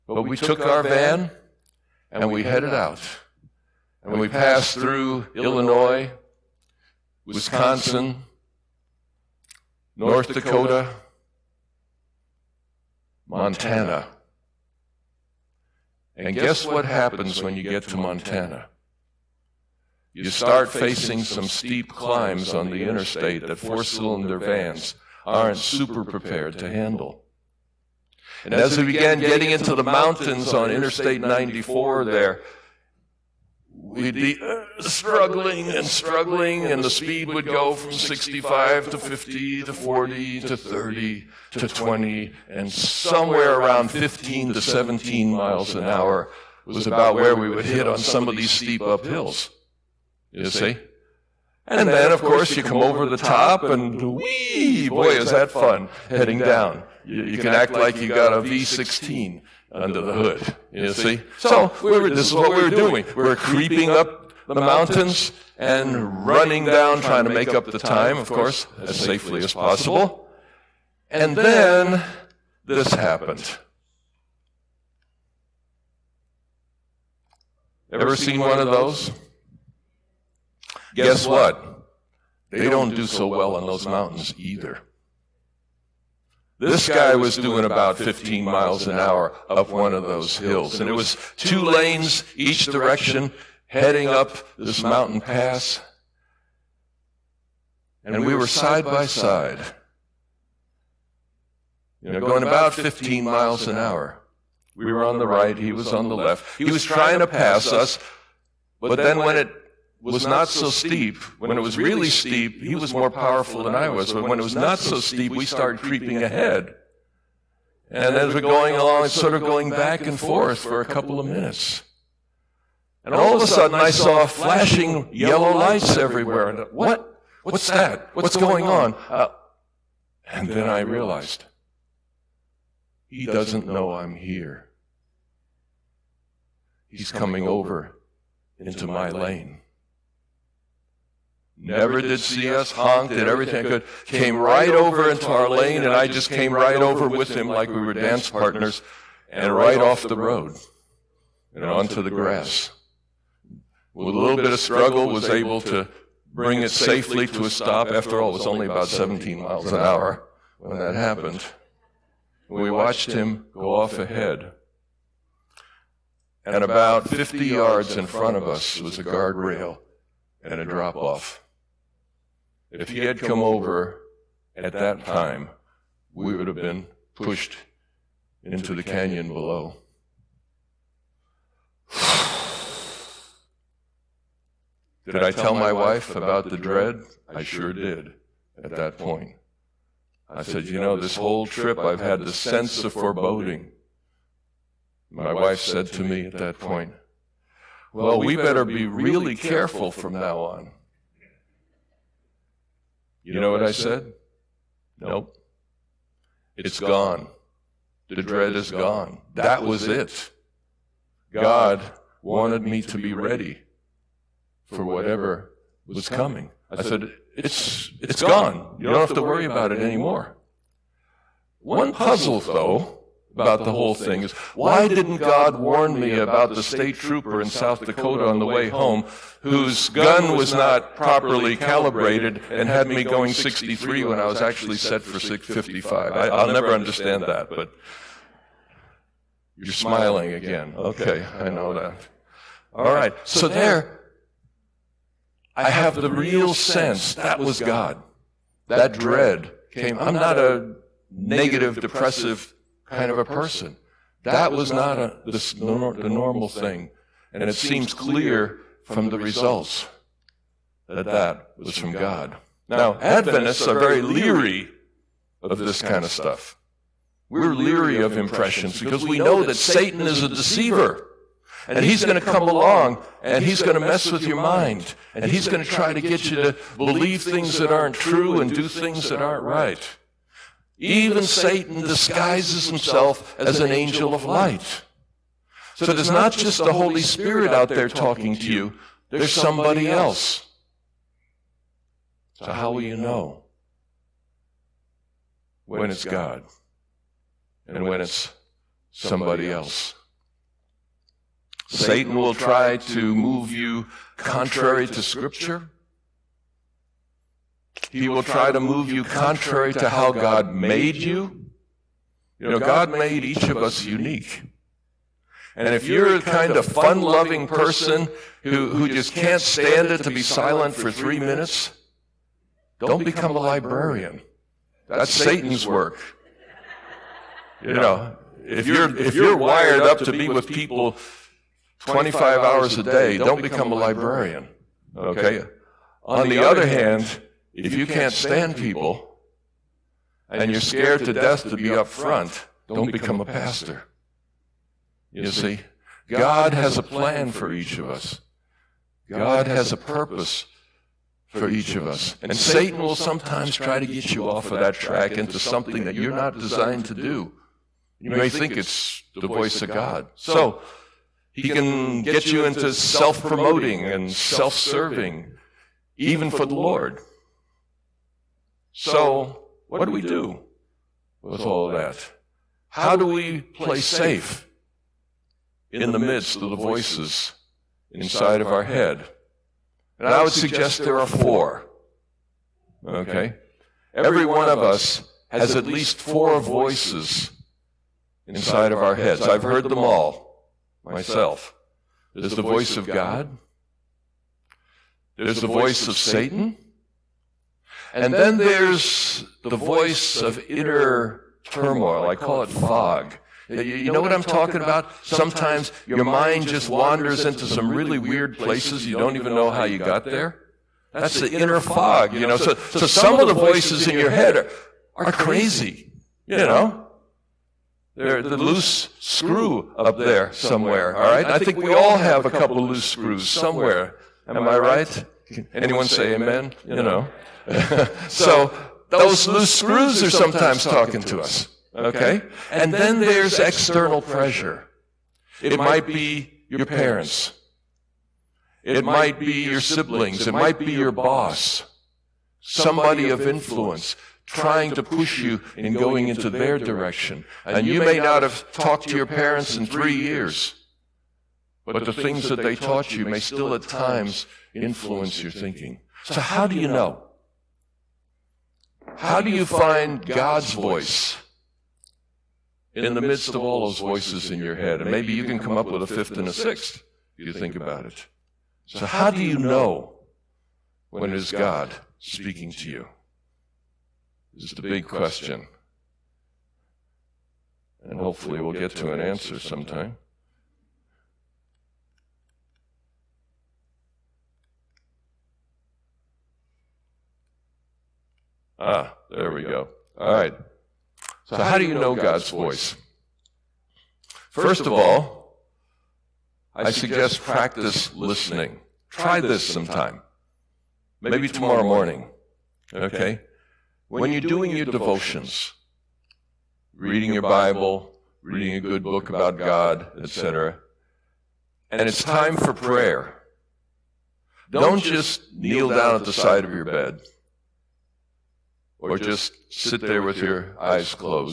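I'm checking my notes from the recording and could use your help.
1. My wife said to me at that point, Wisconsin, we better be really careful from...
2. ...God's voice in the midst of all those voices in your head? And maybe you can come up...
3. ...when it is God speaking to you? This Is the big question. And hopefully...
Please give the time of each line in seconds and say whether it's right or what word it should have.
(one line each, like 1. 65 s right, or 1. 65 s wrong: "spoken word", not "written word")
1. 195 s wrong: "Well", not "Wisconsin"
2. 460 s right
3. 470 s right.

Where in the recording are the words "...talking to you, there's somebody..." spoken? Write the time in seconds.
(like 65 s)
287 s.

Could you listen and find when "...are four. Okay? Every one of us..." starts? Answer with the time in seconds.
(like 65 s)
381 s.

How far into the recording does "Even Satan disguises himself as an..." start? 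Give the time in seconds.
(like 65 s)
280 s.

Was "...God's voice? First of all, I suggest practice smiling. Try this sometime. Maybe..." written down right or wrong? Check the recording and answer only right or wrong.
wrong.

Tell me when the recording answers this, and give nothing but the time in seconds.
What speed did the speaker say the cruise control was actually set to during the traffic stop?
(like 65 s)
235 s.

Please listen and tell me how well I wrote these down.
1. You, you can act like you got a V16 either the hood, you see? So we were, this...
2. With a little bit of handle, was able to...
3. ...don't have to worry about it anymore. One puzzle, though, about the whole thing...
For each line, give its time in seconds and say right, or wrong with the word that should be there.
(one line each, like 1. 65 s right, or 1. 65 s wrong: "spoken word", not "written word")
1. 57 s wrong: "under", not "either"
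2. 153 s wrong: "struggle", not "handle"
3. 218 s right.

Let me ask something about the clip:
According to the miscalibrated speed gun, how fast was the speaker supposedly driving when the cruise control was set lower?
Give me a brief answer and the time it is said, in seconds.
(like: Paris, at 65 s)
63, at 233 s.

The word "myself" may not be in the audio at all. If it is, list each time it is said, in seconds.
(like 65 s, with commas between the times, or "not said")
390 s.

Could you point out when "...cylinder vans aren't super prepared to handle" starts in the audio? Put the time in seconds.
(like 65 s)
23 s.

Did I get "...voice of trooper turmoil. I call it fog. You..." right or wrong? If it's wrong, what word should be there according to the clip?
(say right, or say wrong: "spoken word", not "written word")
wrong: "inner", not "trooper".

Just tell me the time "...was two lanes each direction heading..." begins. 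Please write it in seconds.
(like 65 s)
90 s.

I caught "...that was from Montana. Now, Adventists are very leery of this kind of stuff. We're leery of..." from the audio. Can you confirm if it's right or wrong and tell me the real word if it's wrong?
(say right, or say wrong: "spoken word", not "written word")
wrong: "God", not "Montana".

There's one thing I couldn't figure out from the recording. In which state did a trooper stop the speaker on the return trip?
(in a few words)
South Dakota.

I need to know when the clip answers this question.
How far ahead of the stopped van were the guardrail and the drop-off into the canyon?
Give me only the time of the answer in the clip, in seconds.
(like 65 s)
167 s.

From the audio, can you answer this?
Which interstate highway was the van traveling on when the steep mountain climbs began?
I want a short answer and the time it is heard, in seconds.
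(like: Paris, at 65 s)
Interstate 94, at 30 s.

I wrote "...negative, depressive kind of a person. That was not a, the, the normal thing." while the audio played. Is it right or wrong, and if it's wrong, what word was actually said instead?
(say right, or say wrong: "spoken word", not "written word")
right.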